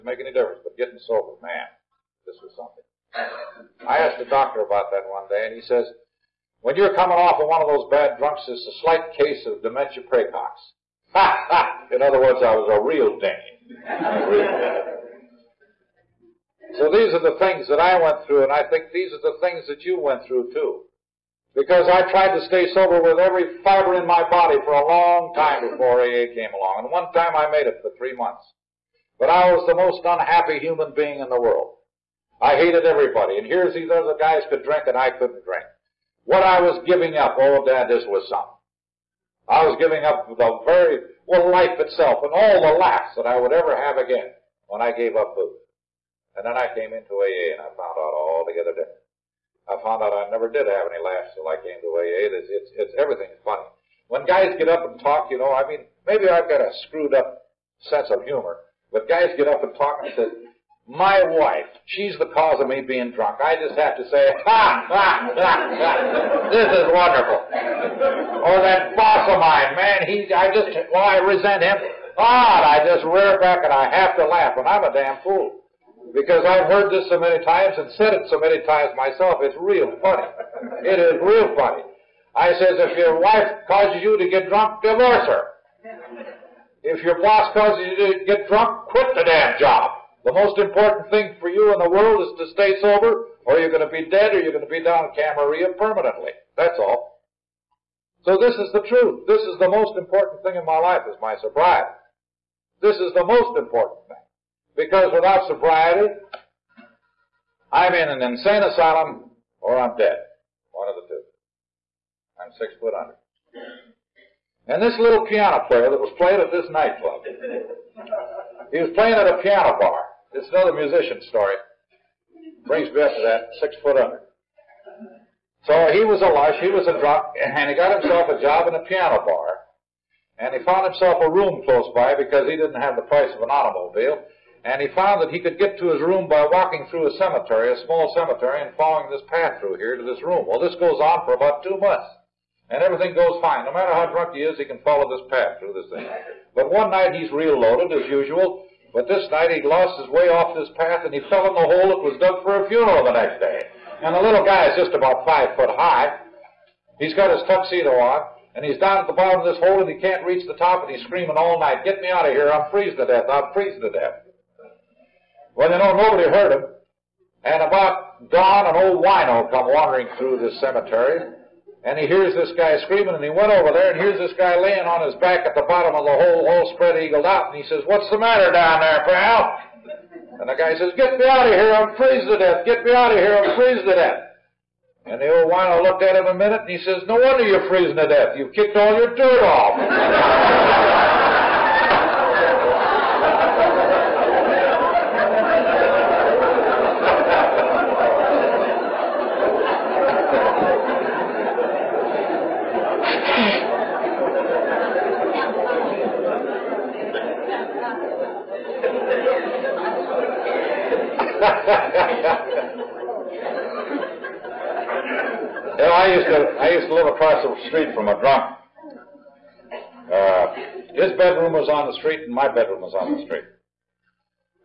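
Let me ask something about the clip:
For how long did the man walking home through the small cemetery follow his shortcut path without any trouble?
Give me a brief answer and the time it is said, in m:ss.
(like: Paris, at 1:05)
2 months, at 2:21.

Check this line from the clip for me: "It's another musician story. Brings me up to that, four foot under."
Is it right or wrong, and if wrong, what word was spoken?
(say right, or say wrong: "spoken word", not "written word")
wrong: "six", not "four".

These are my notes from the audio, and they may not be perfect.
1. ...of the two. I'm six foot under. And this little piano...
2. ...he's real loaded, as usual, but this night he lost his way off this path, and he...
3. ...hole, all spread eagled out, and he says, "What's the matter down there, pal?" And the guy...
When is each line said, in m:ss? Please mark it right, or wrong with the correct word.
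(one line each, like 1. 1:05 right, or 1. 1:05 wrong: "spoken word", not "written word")
1. 1:50 right
2. 2:27 right
3. 2:56 right.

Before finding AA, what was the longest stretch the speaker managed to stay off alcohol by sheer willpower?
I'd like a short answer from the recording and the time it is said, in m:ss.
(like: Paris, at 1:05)
3 months, at 0:27.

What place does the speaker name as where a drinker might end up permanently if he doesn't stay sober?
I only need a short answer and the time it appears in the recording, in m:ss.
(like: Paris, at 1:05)
Camarillo, at 1:35.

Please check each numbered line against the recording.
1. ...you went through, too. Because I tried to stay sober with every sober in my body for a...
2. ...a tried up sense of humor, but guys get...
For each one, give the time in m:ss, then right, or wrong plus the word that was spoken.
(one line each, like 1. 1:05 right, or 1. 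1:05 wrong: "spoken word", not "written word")
1. 0:19 wrong: "fiber", not "sober"
2. 0:56 wrong: "screwed", not "tried".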